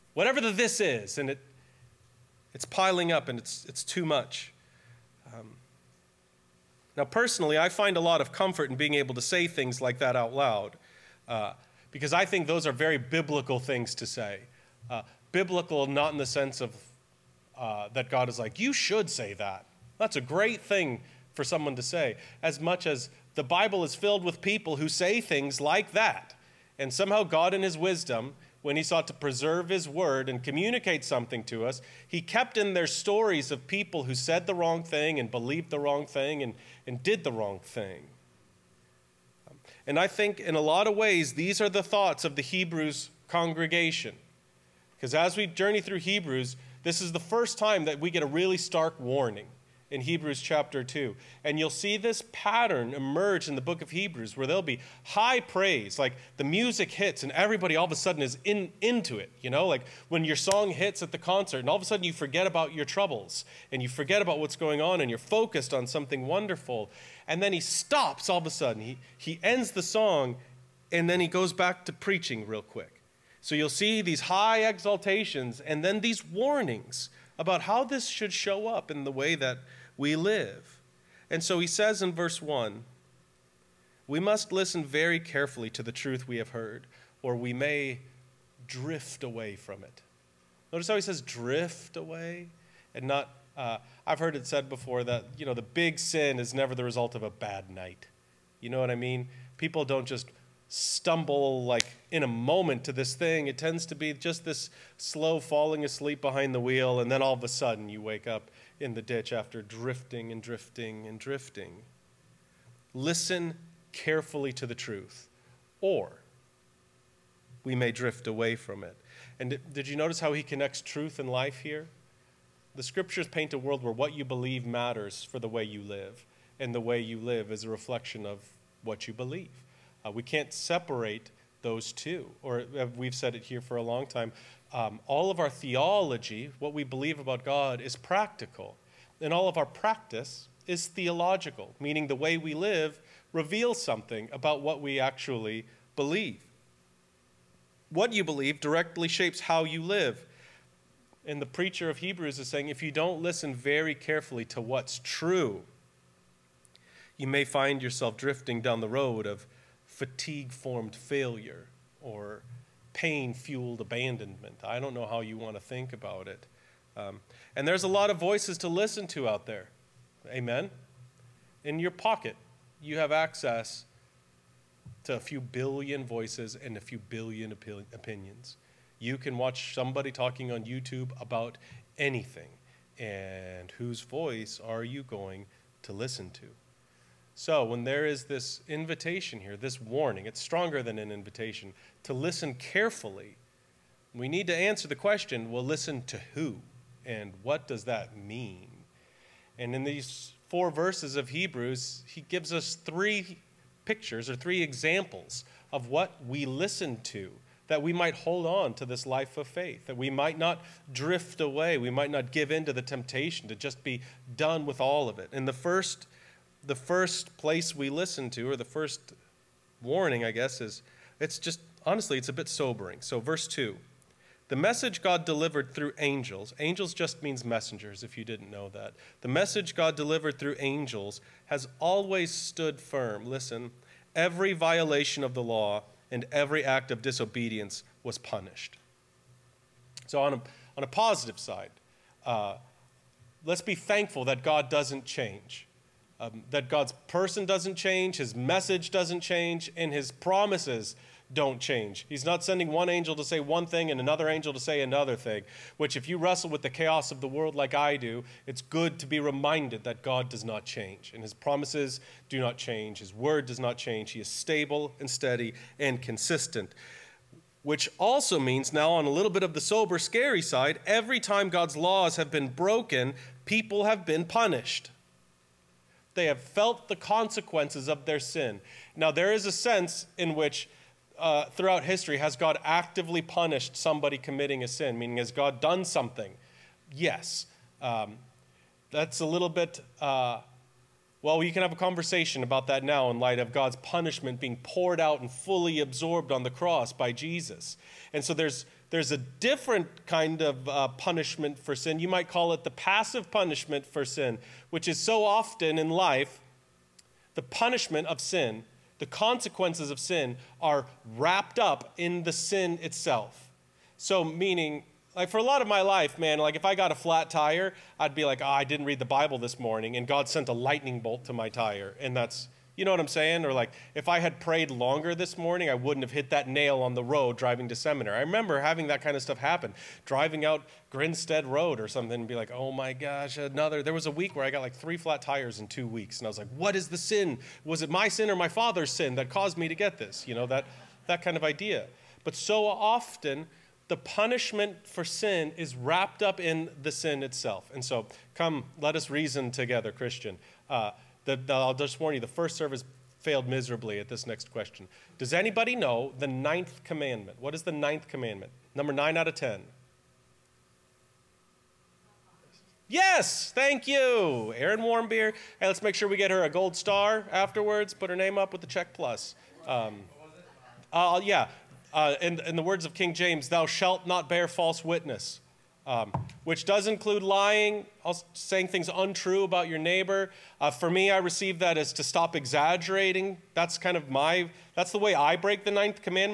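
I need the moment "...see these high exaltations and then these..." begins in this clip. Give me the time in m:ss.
1:13.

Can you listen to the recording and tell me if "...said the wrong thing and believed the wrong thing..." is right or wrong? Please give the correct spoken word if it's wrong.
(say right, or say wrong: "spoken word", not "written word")
right.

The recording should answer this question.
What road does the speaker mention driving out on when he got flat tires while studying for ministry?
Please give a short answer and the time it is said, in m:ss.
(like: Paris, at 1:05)
Grinstead Road, at 5:30.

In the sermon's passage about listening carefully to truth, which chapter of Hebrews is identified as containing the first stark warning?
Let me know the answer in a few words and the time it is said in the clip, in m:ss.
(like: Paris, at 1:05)
Chapter 2, at 0:50.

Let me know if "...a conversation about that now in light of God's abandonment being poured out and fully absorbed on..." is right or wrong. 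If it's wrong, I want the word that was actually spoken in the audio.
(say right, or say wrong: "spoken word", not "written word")
wrong: "punishment", not "abandonment".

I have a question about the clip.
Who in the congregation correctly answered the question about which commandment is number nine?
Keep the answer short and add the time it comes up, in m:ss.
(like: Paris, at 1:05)
Erin Warmbier, at 6:04.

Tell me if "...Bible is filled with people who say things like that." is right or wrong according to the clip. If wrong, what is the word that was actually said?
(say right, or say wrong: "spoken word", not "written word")
right.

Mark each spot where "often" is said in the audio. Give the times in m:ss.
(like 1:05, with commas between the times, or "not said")
5:05, 5:42.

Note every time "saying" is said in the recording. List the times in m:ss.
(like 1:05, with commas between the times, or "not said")
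2:32, 5:23, 6:18.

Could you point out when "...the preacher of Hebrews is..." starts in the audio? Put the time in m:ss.
2:31.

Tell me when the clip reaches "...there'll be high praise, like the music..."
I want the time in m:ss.
0:54.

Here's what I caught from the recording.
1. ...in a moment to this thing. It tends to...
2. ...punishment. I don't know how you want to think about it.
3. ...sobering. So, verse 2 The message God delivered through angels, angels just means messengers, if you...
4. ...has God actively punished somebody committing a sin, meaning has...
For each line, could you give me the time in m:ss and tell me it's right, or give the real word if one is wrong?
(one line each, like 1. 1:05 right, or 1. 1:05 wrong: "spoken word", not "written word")
1. 1:42 right
2. 2:43 wrong: "abandonment", not "punishment"
3. 3:42 right
4. 4:42 right.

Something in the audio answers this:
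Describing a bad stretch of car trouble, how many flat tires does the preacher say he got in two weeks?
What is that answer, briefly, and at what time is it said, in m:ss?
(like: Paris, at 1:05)
3, at 5:34.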